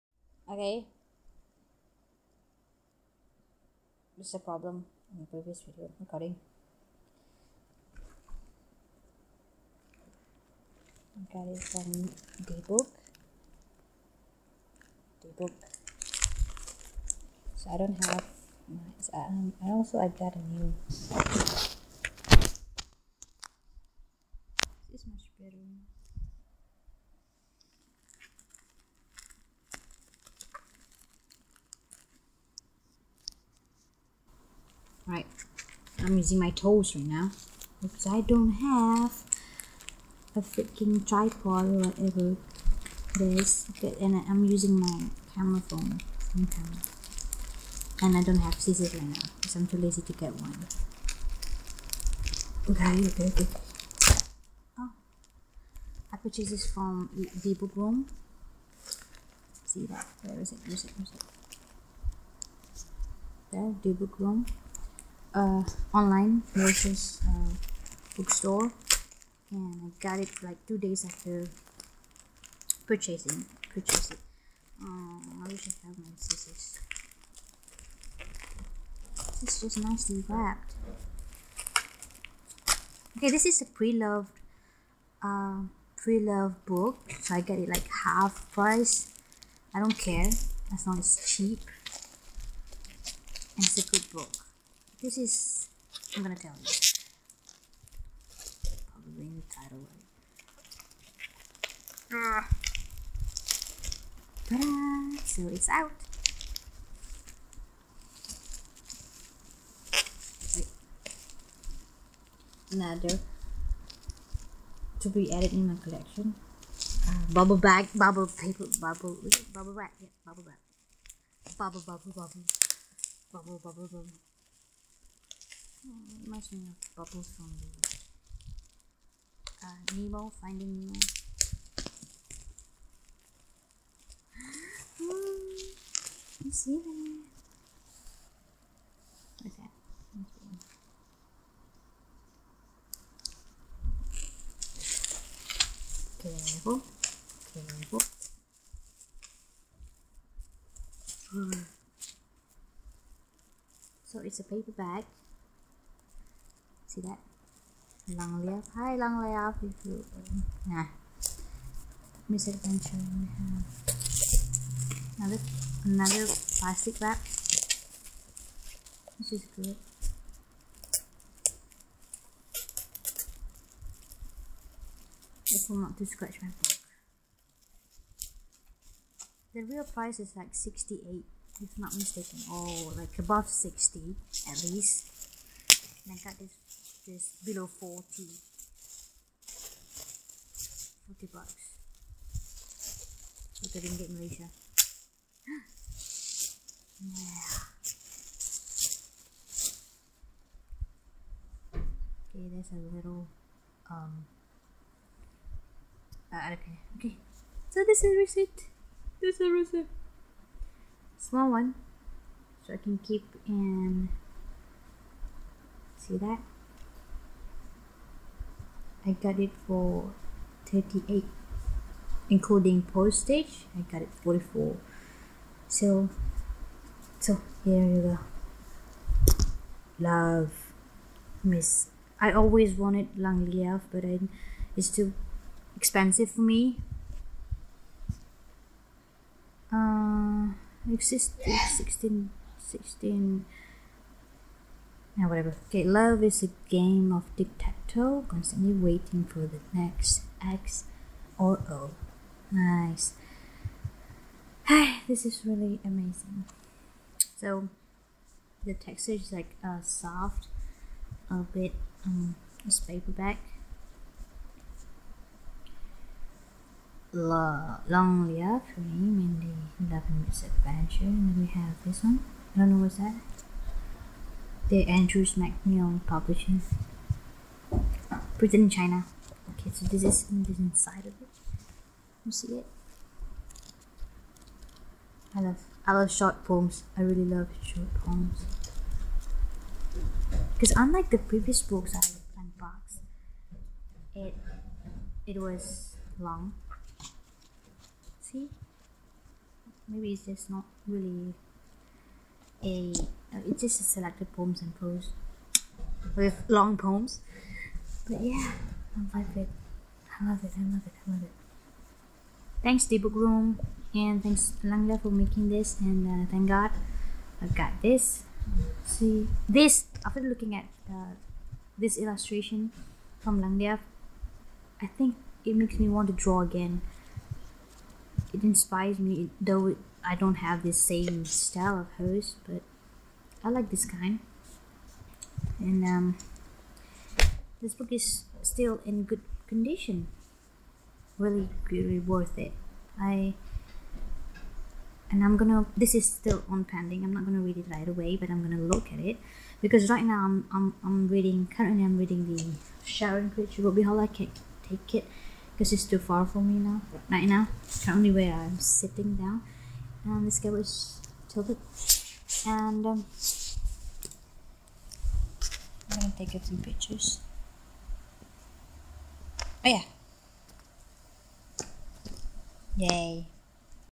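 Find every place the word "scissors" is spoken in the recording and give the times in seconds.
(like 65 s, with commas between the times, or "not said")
48 s, 76 s.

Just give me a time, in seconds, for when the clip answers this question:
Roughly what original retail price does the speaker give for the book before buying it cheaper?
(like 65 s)
180 s.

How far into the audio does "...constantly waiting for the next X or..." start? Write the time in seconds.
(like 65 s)
248 s.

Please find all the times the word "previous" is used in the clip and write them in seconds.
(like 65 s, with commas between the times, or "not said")
5 s, 291 s.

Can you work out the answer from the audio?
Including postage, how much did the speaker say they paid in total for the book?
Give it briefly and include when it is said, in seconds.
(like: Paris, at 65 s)
44, at 224 s.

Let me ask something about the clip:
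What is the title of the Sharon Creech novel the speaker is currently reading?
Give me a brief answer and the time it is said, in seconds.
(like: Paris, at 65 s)
Ruby Holler, at 353 s.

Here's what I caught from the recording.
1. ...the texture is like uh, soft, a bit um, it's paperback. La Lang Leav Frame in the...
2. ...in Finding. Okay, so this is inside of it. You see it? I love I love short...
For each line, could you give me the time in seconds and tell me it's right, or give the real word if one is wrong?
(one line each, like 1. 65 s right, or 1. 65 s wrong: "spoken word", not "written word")
1. 258 s right
2. 278 s wrong: "China", not "Finding".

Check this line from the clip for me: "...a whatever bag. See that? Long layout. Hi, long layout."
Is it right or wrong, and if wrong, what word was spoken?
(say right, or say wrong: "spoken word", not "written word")
wrong: "paper", not "whatever".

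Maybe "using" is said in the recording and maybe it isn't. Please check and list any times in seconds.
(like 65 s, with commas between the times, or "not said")
36 s, 44 s.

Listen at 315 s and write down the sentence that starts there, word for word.
And uh, thank God, I got this.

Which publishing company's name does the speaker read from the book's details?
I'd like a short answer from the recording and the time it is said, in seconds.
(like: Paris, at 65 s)
Andrews McMeel Publishing, at 274 s.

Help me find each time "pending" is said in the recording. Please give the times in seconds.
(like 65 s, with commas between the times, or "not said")
346 s.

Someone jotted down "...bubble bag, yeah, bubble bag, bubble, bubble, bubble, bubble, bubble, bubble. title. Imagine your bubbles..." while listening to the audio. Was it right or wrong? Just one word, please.
wrong.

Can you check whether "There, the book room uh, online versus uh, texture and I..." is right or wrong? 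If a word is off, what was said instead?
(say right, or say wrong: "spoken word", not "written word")
wrong: "bookstore", not "texture".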